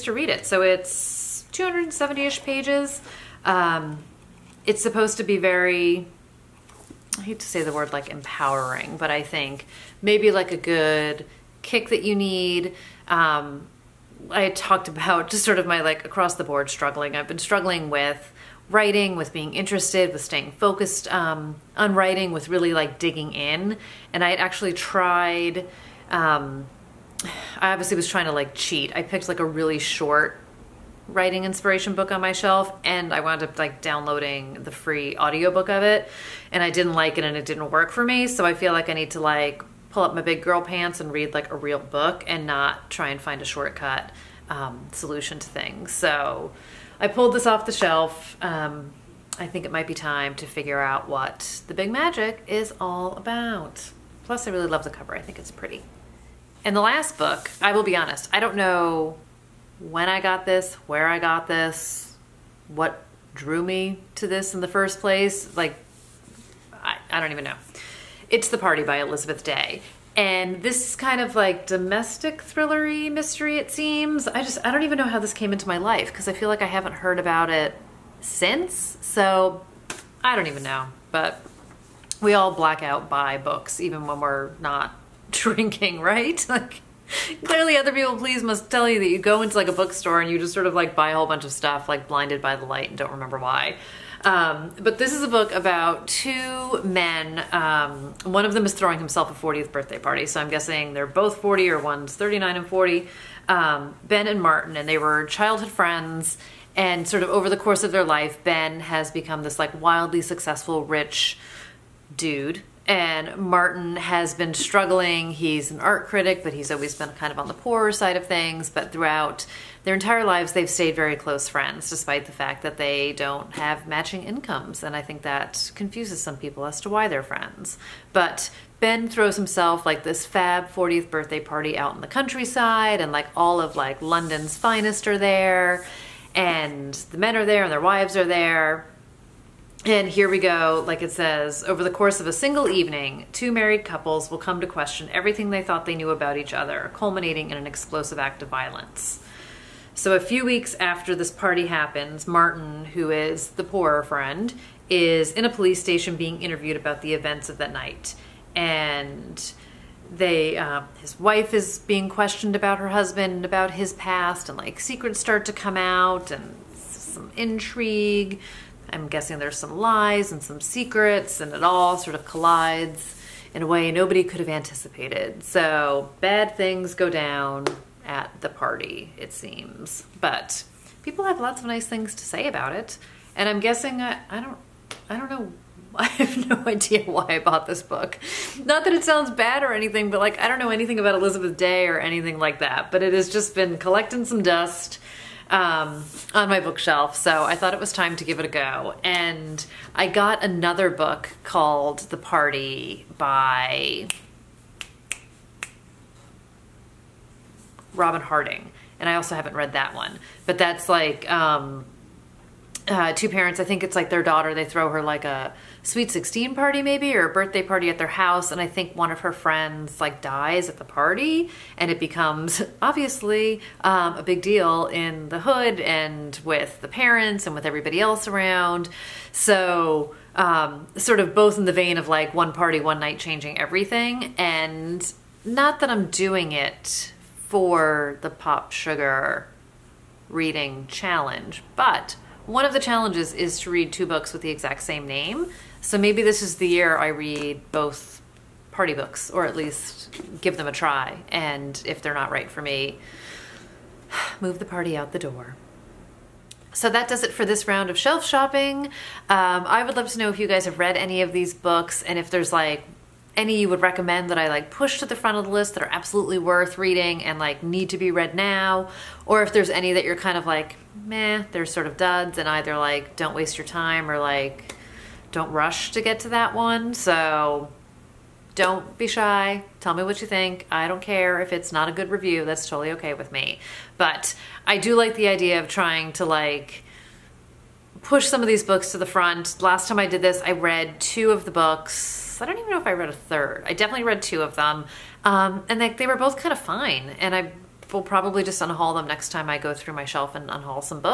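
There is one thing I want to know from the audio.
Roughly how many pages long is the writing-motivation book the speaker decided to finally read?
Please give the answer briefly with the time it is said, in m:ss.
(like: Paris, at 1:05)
270, at 0:01.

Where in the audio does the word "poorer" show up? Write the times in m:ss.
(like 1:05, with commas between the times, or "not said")
1:57, 2:33.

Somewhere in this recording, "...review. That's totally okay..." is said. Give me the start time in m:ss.
4:42.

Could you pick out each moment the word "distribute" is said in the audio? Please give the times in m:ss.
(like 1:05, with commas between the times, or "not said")
not said.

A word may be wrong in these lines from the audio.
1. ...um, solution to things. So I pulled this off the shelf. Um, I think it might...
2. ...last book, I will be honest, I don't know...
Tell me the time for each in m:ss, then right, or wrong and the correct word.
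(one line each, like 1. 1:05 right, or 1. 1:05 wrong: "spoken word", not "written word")
1. 0:44 right
2. 0:56 right.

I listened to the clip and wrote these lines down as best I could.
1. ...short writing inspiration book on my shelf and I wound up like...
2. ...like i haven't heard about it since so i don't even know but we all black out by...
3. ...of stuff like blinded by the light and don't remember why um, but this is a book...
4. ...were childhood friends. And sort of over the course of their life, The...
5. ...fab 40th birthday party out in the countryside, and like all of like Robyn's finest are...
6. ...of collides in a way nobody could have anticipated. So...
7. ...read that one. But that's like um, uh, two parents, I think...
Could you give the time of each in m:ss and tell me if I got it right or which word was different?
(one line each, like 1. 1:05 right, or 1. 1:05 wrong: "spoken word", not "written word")
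1. 0:29 right
2. 1:16 right
3. 1:31 right
4. 1:44 wrong: "Ben", not "The"
5. 2:10 wrong: "London", not "Robyn"
6. 2:52 right
7. 3:29 right.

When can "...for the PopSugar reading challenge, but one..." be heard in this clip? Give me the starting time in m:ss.
3:57.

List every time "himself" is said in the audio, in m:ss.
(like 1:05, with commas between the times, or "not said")
1:38, 2:09.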